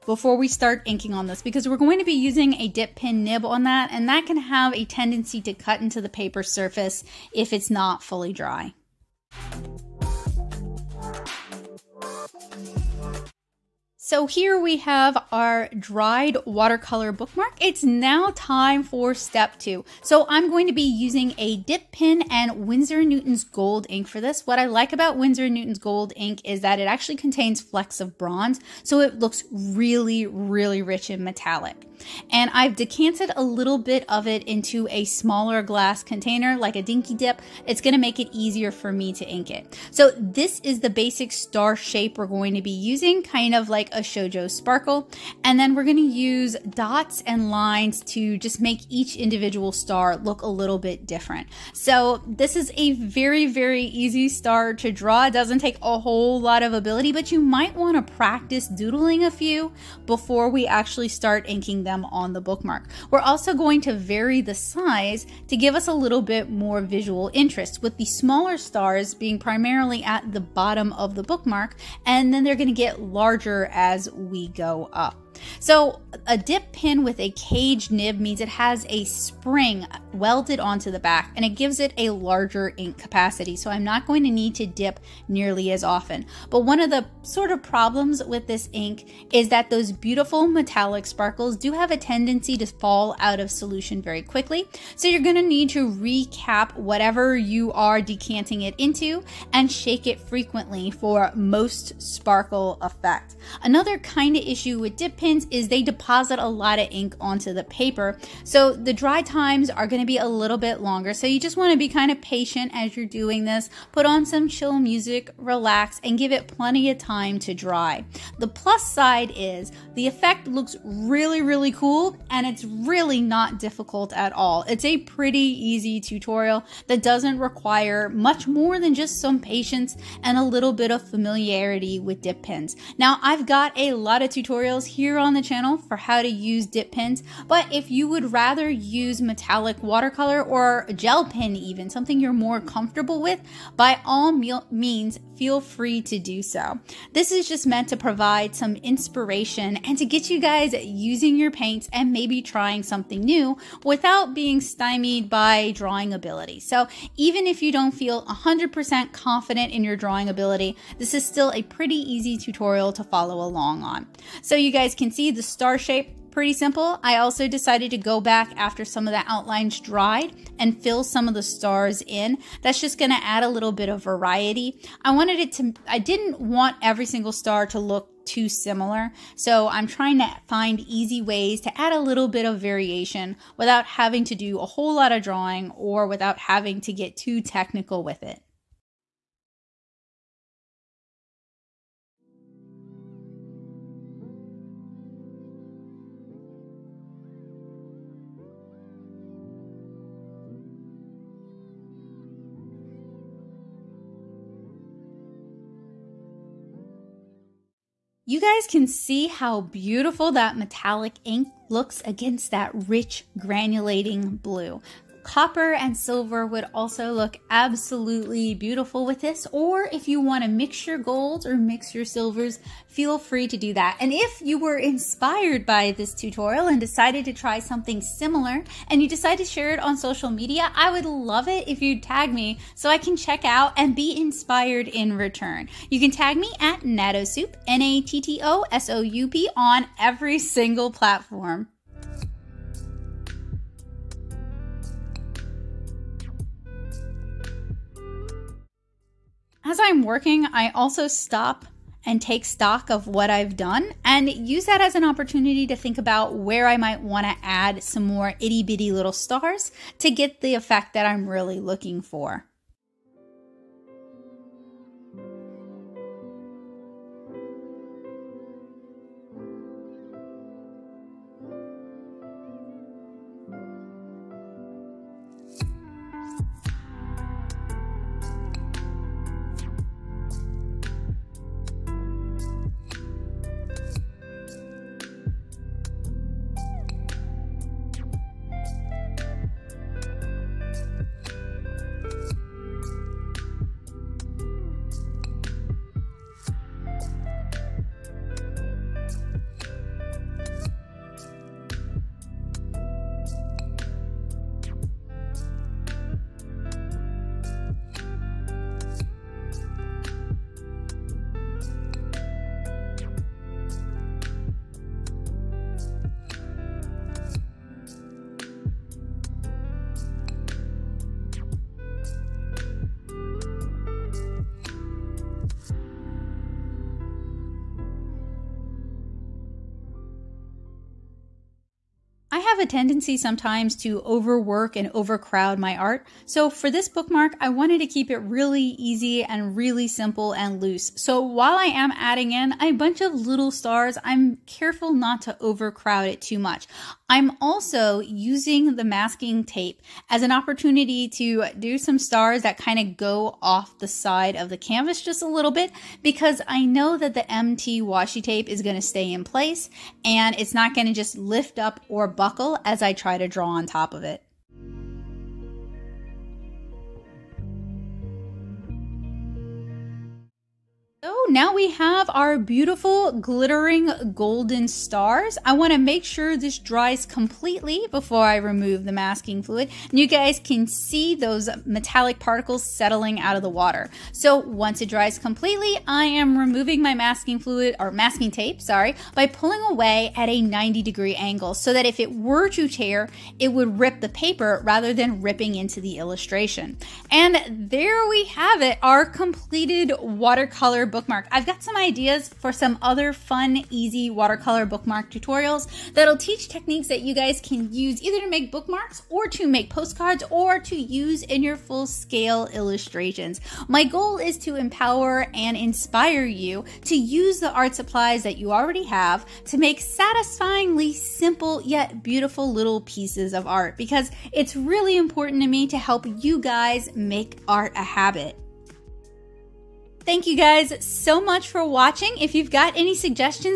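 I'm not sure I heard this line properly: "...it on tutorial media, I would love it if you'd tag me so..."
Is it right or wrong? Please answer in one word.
wrong.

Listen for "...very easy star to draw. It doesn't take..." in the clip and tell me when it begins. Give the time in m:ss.
0:53.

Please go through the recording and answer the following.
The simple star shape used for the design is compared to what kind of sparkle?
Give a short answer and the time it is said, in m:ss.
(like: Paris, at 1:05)
Shoujo sparkle, at 0:44.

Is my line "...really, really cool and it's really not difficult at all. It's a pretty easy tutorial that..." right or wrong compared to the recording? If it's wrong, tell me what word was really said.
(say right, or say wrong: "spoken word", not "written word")
right.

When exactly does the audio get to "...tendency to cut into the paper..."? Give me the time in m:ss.
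0:04.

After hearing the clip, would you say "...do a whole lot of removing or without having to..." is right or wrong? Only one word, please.
wrong.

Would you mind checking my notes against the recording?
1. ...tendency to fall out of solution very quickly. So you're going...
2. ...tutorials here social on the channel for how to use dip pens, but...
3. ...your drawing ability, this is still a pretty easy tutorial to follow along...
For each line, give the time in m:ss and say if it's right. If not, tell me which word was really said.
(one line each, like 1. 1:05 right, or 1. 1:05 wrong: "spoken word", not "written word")
1. 1:31 right
2. 2:14 wrong: "tutorial", not "social"
3. 2:39 right.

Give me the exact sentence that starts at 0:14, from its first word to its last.
So here we have our dried watercolor bookmark.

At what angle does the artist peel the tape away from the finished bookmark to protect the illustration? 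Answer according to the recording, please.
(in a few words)
90 degrees.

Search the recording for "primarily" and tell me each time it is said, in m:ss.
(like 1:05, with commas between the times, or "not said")
1:09.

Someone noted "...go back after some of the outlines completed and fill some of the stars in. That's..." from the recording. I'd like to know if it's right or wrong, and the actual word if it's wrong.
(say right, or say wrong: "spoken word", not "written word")
wrong: "dried", not "completed".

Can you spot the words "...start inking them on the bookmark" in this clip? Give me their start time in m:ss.
1:01.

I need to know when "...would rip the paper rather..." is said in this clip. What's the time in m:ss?
6:33.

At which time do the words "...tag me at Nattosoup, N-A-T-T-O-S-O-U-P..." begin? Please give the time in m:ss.
3:56.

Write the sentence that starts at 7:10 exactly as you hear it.
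Thank you guys so much for watching.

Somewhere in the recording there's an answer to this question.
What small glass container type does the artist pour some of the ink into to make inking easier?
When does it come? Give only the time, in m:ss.
0:36.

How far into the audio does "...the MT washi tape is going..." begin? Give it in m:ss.
5:57.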